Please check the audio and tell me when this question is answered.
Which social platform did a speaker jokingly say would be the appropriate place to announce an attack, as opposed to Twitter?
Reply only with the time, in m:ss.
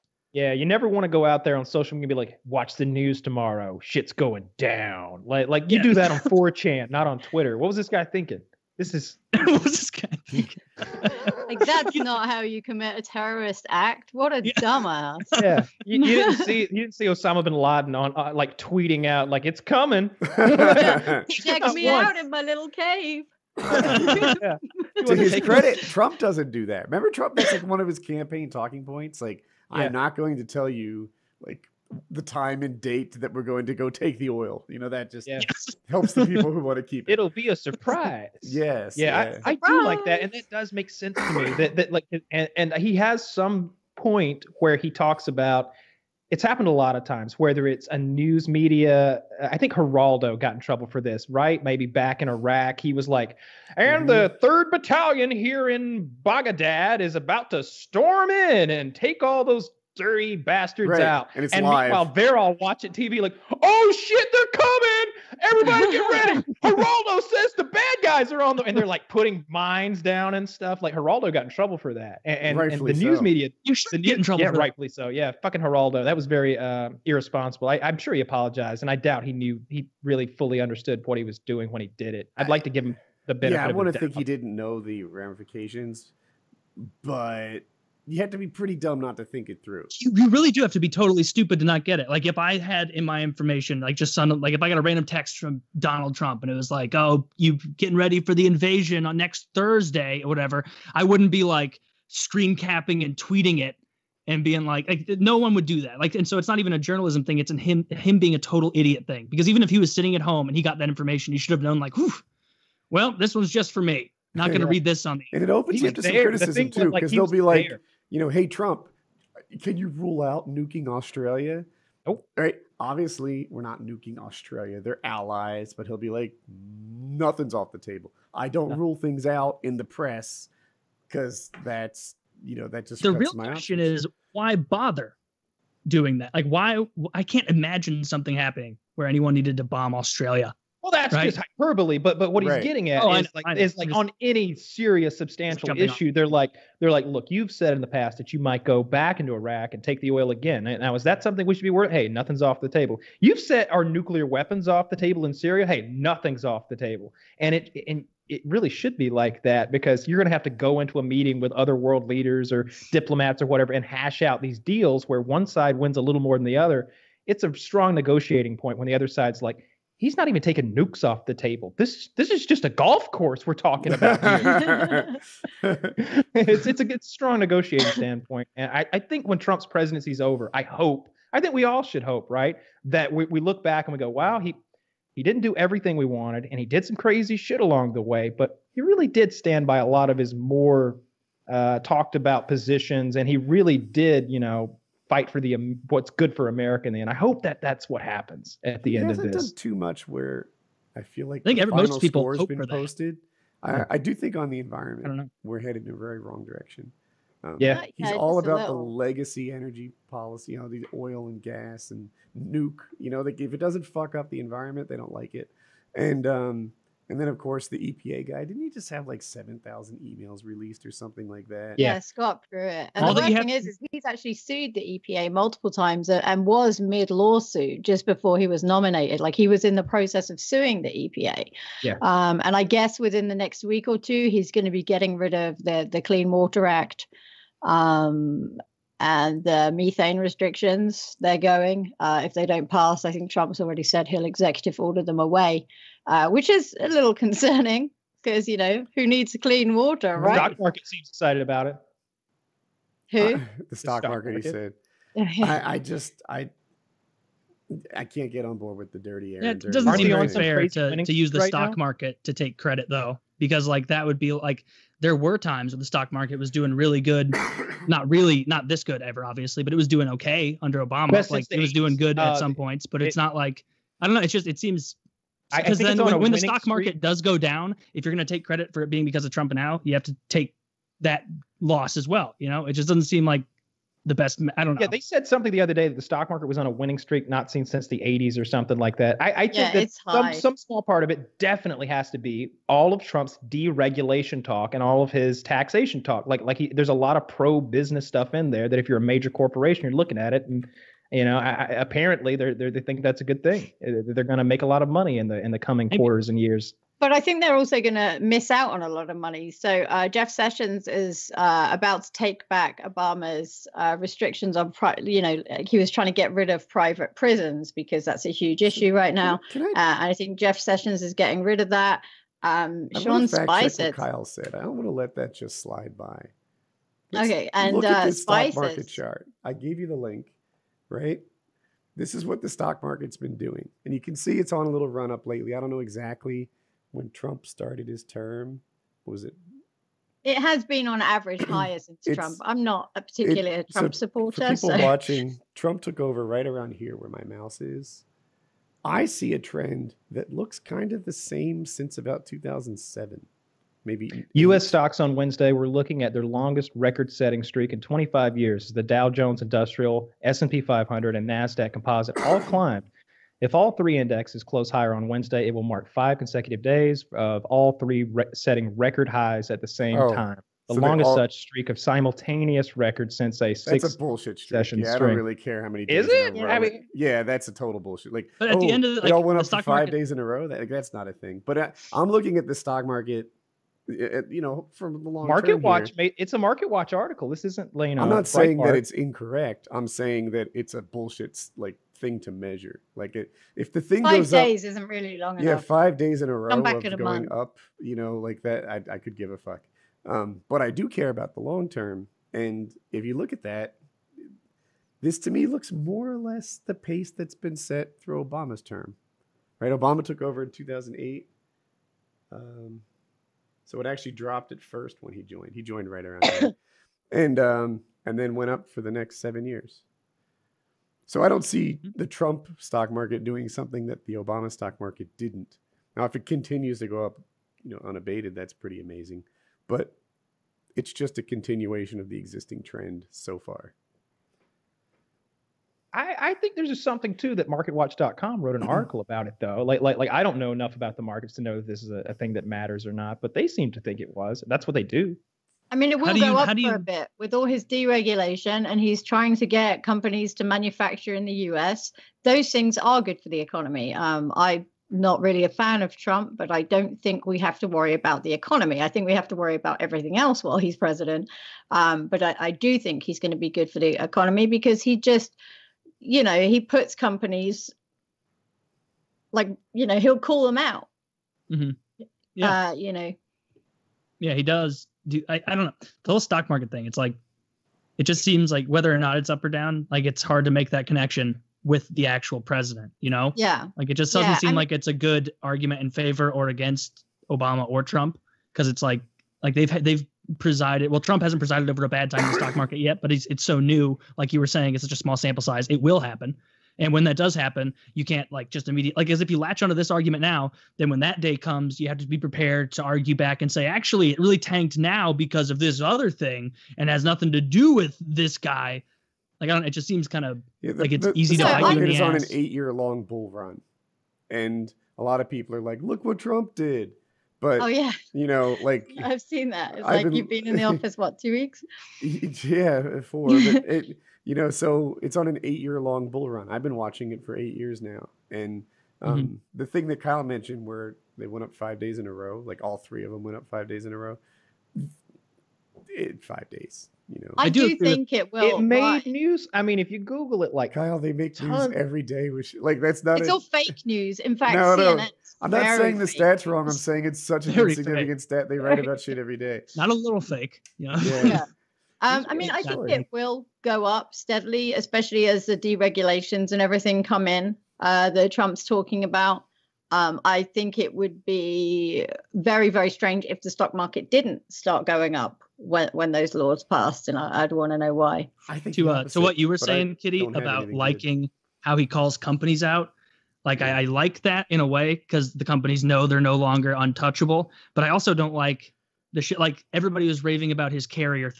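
0:06.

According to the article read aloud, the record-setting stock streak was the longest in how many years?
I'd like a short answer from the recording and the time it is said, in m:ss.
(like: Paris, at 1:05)
25, at 5:57.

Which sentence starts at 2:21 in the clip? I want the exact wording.
just hyperbole, but but what he's right.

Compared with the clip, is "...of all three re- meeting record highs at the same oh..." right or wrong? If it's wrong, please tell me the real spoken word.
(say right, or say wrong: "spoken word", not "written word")
wrong: "setting", not "meeting".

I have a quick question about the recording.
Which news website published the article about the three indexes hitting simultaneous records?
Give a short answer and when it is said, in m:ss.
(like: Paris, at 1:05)
MarketWatch.com, at 7:17.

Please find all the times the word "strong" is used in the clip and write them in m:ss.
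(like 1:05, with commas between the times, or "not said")
2:47, 2:57.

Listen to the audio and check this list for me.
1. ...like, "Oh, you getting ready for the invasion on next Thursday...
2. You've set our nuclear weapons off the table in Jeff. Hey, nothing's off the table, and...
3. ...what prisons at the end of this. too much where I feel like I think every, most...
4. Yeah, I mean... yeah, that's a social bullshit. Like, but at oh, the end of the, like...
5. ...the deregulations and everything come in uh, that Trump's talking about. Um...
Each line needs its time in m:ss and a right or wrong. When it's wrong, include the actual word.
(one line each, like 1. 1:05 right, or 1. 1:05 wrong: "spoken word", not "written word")
1. 1:36 right
2. 2:33 wrong: "Syria", not "Jeff"
3. 3:17 wrong: "happens", not "prisons"
4. 6:16 wrong: "total", not "social"
5. 9:15 right.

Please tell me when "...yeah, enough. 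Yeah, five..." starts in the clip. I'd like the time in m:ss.
6:35.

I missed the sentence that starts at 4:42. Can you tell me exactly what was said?
You know, it just doesn't seem like the best.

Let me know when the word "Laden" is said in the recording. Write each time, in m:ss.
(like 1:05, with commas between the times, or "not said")
0:17.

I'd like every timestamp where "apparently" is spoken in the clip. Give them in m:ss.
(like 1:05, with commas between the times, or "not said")
5:01.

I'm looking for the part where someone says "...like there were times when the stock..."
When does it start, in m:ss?
4:24.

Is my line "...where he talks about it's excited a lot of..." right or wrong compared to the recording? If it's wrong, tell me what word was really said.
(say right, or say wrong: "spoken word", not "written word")
wrong: "happened", not "excited".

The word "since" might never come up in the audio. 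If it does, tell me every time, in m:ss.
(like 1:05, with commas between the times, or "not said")
4:47, 5:41, 5:51, 6:13.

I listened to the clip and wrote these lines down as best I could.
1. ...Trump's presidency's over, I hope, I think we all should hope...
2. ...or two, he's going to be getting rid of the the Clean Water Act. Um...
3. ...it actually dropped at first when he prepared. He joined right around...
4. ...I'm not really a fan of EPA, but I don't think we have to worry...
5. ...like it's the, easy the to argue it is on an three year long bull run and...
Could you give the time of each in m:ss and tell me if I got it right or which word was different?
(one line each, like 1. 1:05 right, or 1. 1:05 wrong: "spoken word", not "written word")
1. 2:59 right
2. 3:53 right
3. 6:53 wrong: "joined", not "prepared"
4. 7:34 wrong: "Trump", not "EPA"
5. 8:30 wrong: "eight", not "three".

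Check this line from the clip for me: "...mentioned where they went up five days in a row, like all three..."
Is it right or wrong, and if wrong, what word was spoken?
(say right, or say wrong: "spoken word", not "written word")
right.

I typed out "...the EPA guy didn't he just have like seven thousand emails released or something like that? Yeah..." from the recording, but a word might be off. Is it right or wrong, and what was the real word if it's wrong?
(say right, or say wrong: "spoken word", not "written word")
right.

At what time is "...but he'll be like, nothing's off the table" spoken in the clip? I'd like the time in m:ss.
2:05.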